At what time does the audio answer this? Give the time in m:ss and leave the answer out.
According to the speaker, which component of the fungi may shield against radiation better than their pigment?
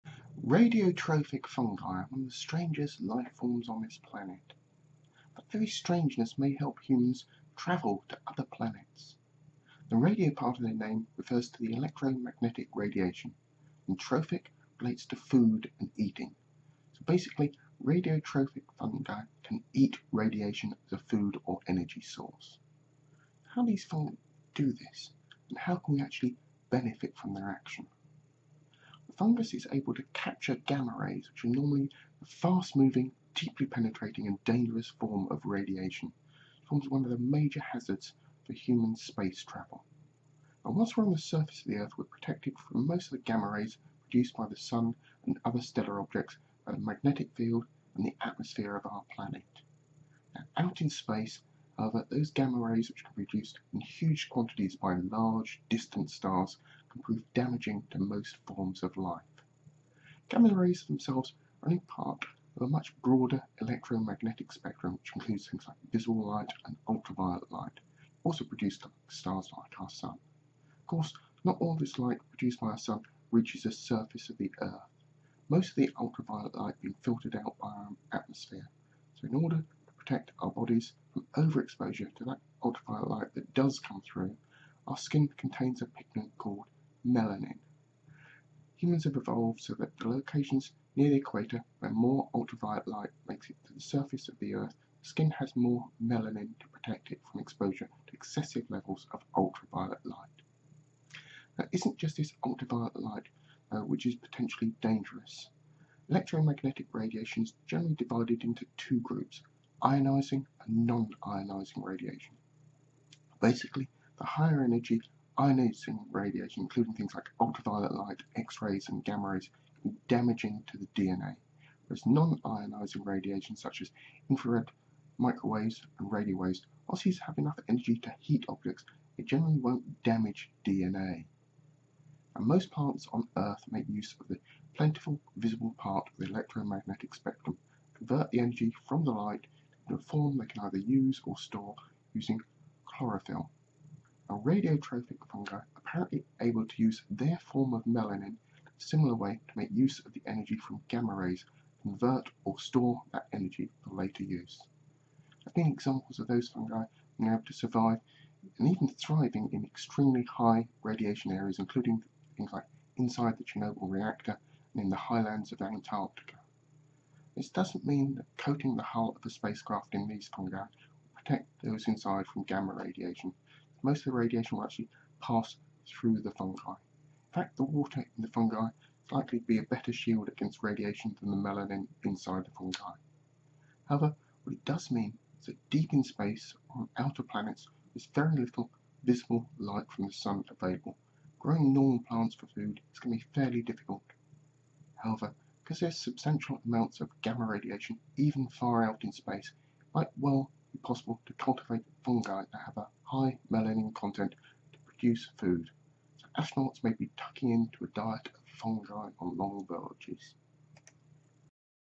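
2:57.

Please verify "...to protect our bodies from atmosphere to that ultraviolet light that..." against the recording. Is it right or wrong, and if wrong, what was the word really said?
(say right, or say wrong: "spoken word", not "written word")
wrong: "overexposure", not "atmosphere".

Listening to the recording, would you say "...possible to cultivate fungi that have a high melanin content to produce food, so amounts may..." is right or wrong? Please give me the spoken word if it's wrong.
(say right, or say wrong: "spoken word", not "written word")
wrong: "astronauts", not "amounts".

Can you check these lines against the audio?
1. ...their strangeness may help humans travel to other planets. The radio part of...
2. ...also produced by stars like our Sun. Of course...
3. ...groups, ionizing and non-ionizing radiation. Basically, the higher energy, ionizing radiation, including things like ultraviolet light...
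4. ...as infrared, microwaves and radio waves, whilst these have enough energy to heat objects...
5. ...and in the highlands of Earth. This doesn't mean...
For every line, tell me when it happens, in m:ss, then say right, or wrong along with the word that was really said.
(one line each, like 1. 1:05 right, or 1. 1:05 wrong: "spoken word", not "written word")
1. 0:05 right
2. 1:08 right
3. 1:48 right
4. 2:03 right
5. 2:44 wrong: "Antarctica", not "Earth".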